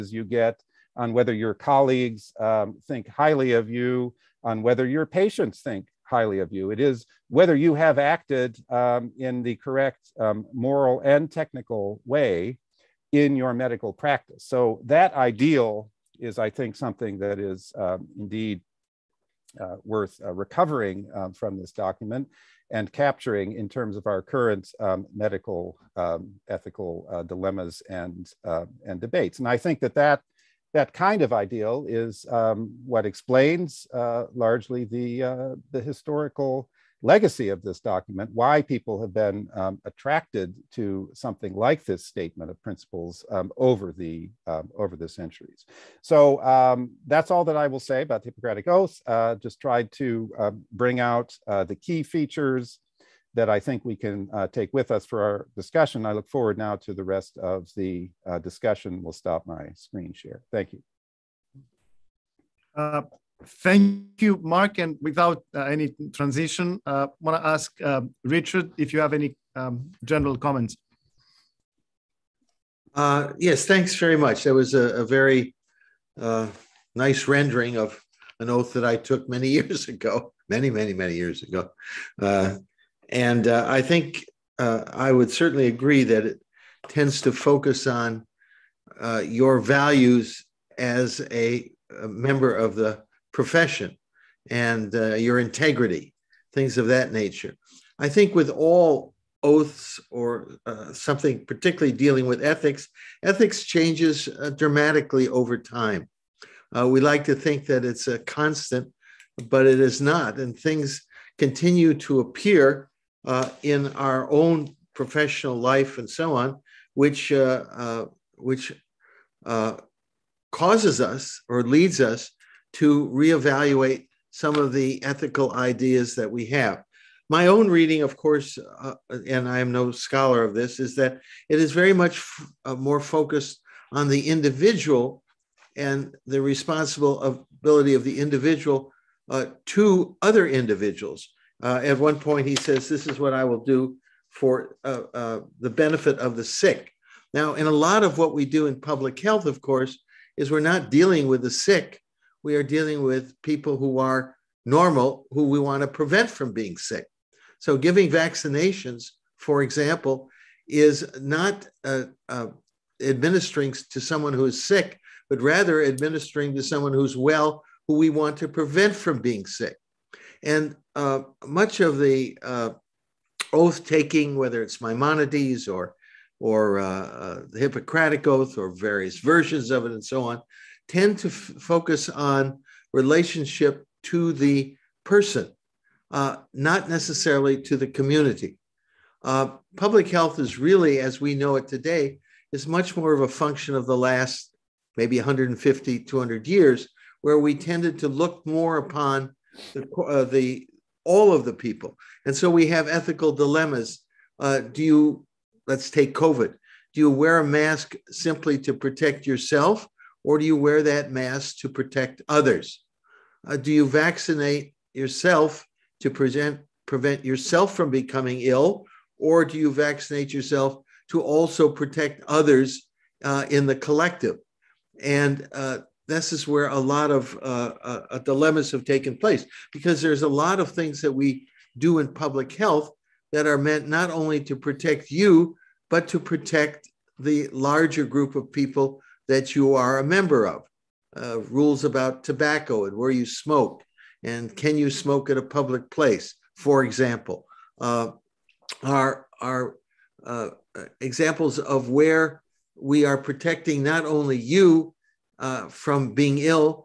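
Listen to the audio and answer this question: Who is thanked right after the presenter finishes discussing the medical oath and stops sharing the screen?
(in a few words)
Mark.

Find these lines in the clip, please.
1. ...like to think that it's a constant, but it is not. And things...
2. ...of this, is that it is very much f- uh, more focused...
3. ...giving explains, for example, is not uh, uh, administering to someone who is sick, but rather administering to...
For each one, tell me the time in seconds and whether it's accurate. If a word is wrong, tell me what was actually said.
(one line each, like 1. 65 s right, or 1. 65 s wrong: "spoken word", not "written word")
1. 107 s right
2. 130 s right
3. 157 s wrong: "vaccinations", not "explains".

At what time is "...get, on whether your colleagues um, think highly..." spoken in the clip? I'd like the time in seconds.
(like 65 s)
0 s.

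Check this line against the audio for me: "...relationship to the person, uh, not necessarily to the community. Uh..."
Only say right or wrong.
right.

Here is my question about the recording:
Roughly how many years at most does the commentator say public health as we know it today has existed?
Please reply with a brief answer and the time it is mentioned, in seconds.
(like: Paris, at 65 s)
200, at 196 s.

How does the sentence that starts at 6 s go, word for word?
It is whether you have acted um, in the correct um, moral and technical way in your medical practice.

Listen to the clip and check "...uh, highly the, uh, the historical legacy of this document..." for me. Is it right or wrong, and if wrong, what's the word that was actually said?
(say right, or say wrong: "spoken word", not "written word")
wrong: "largely", not "highly".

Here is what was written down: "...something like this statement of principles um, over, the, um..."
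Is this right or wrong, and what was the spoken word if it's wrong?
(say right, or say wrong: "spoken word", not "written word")
right.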